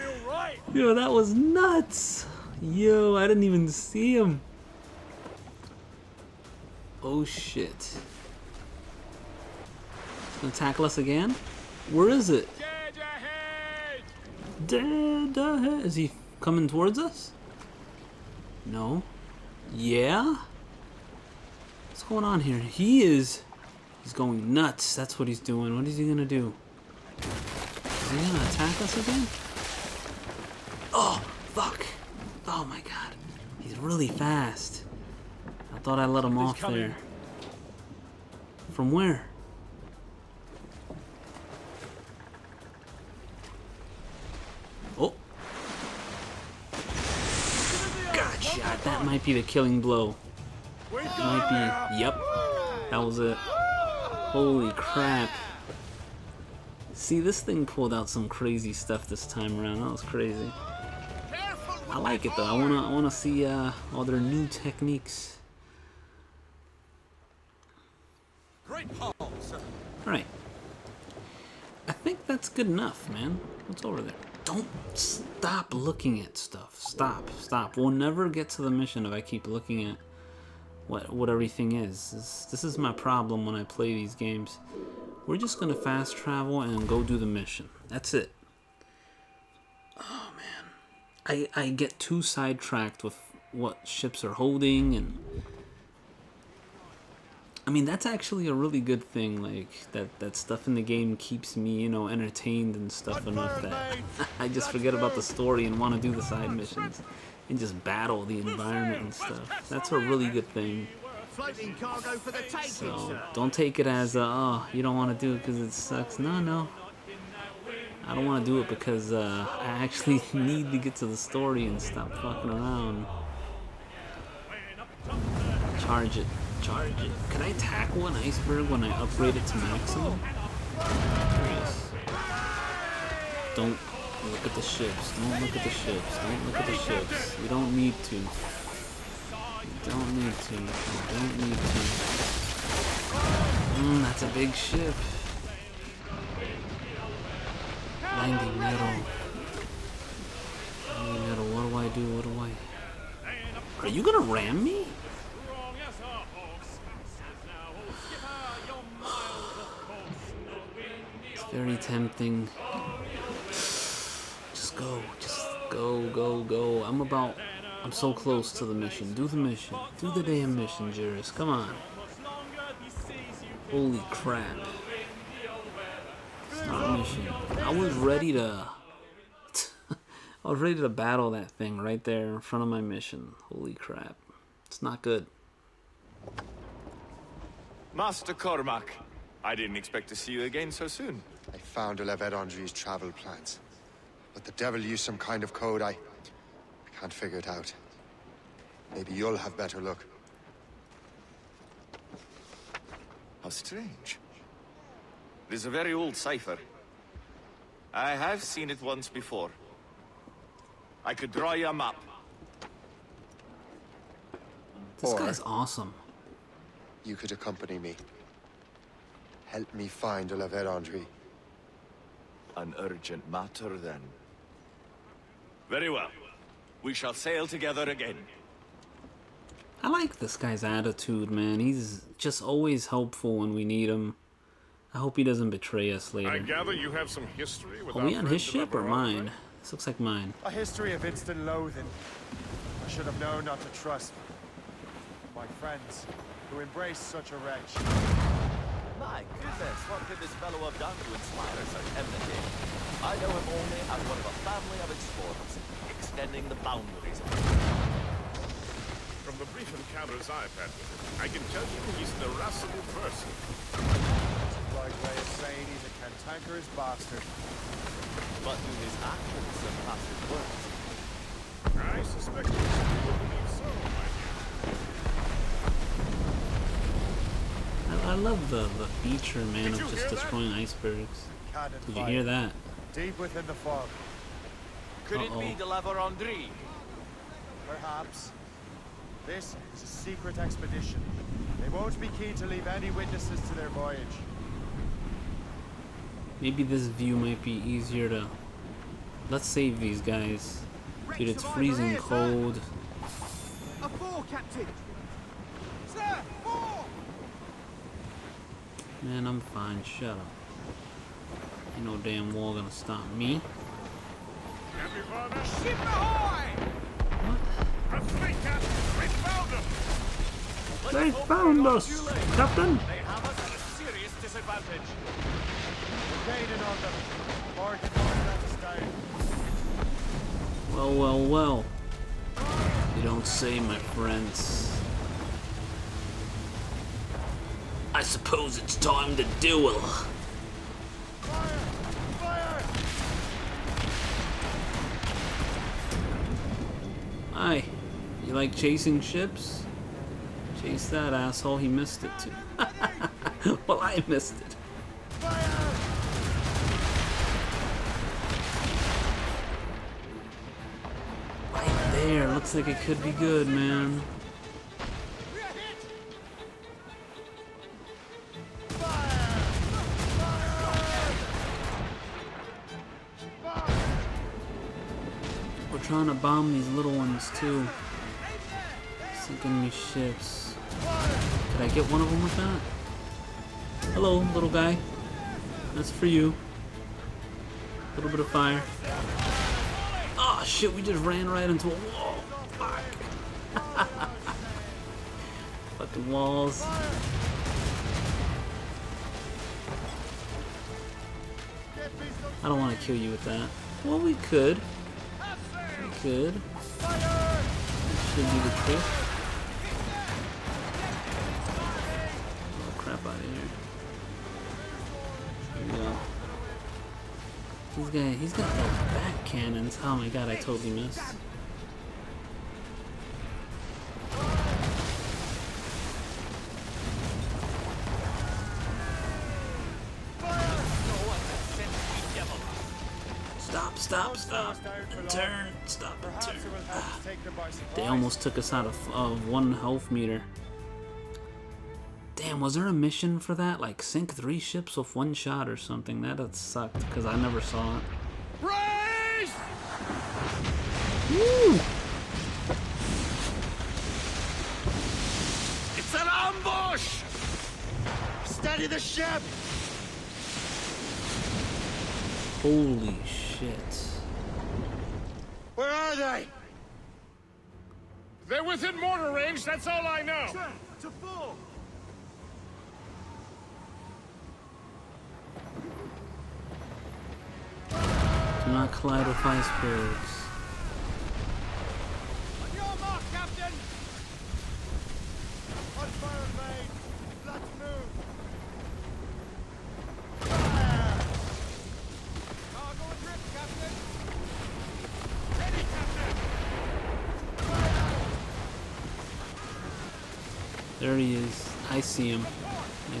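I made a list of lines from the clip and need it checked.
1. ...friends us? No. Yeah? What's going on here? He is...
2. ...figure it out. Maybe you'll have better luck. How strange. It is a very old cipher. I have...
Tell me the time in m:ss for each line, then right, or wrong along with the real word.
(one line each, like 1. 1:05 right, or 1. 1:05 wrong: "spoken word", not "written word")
1. 0:16 wrong: "towards", not "friends"
2. 3:17 right.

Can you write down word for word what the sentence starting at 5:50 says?
Chase that asshole, he missed it too.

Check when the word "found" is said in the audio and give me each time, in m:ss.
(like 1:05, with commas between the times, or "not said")
3:11, 5:21.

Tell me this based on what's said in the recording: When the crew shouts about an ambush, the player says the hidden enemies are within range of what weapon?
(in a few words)
mortar.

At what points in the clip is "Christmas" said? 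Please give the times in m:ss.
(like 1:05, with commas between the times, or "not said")
not said.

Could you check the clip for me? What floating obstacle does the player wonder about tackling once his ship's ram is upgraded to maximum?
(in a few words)
iceberg.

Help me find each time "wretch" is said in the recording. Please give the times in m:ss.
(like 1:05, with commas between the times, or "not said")
4:07.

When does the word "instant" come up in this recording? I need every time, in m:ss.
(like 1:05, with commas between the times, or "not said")
4:01.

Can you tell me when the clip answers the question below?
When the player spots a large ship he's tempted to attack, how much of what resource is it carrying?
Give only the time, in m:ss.
2:28.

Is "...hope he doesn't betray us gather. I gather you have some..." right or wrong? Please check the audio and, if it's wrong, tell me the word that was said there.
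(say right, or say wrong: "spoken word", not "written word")
wrong: "later", not "gather".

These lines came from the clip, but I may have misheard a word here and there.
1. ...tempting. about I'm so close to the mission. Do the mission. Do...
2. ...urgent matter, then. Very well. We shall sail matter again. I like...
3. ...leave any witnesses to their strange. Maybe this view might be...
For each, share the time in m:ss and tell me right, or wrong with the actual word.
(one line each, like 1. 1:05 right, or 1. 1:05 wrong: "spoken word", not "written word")
1. 2:41 right
2. 3:42 wrong: "together", not "matter"
3. 4:52 wrong: "voyage", not "strange".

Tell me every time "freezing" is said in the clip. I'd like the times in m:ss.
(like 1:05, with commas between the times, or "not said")
5:01.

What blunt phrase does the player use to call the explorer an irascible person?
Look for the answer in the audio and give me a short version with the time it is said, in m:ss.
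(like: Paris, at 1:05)
cantankerous bastard, at 4:25.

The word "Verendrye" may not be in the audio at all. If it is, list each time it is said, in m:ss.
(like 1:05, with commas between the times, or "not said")
3:12, 3:40, 4:45.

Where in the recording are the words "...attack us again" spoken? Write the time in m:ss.
0:28.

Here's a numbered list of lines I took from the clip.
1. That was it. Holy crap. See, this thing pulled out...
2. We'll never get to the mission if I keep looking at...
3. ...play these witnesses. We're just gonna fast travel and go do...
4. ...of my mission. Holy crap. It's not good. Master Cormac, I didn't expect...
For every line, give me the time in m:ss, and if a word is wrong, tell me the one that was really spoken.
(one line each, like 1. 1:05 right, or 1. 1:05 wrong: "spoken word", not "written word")
1. 0:52 right
2. 1:17 right
3. 1:23 wrong: "games", not "witnesses"
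4. 3:02 right.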